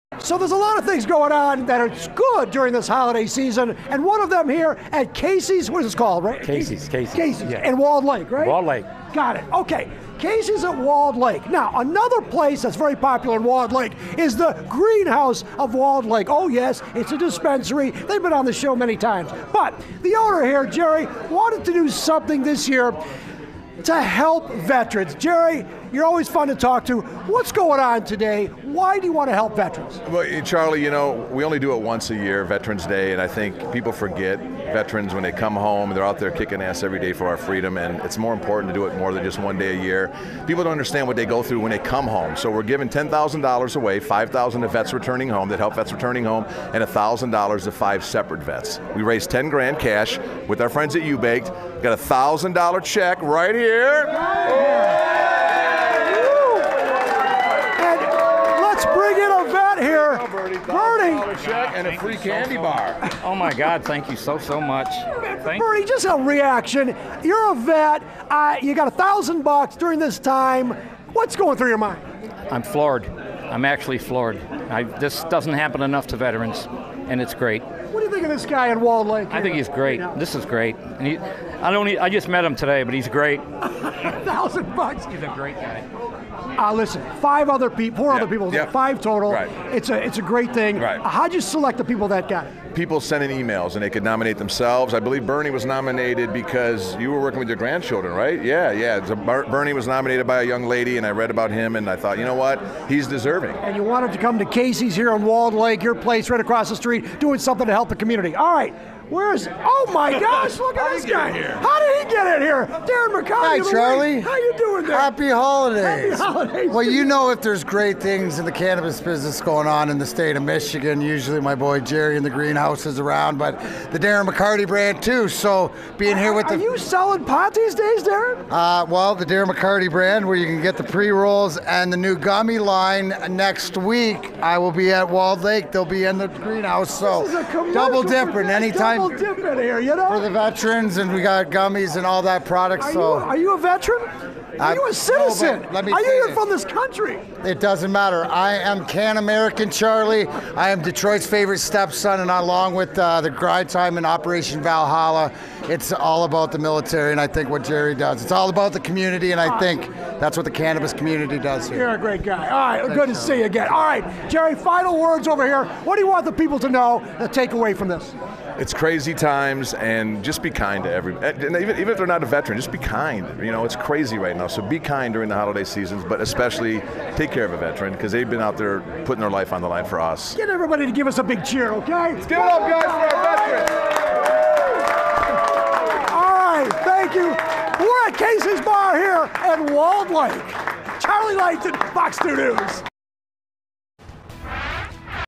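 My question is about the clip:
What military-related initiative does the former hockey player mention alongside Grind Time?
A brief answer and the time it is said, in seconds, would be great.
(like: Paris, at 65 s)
Operation Valhalla, at 154 s.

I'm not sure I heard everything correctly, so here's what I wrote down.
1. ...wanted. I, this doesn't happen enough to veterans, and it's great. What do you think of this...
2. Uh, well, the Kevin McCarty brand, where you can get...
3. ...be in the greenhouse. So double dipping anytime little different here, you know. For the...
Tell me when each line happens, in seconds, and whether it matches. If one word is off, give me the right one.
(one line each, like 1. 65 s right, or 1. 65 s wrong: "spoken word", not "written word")
1. 73 s wrong: "floored", not "wanted"
2. 128 s wrong: "Darren", not "Kevin"
3. 135 s right.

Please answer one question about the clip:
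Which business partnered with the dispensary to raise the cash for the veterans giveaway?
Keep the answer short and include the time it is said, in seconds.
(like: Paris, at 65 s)
U-Baked, at 51 s.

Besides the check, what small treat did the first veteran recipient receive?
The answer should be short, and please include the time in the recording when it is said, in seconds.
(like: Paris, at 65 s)
a free candy bar, at 61 s.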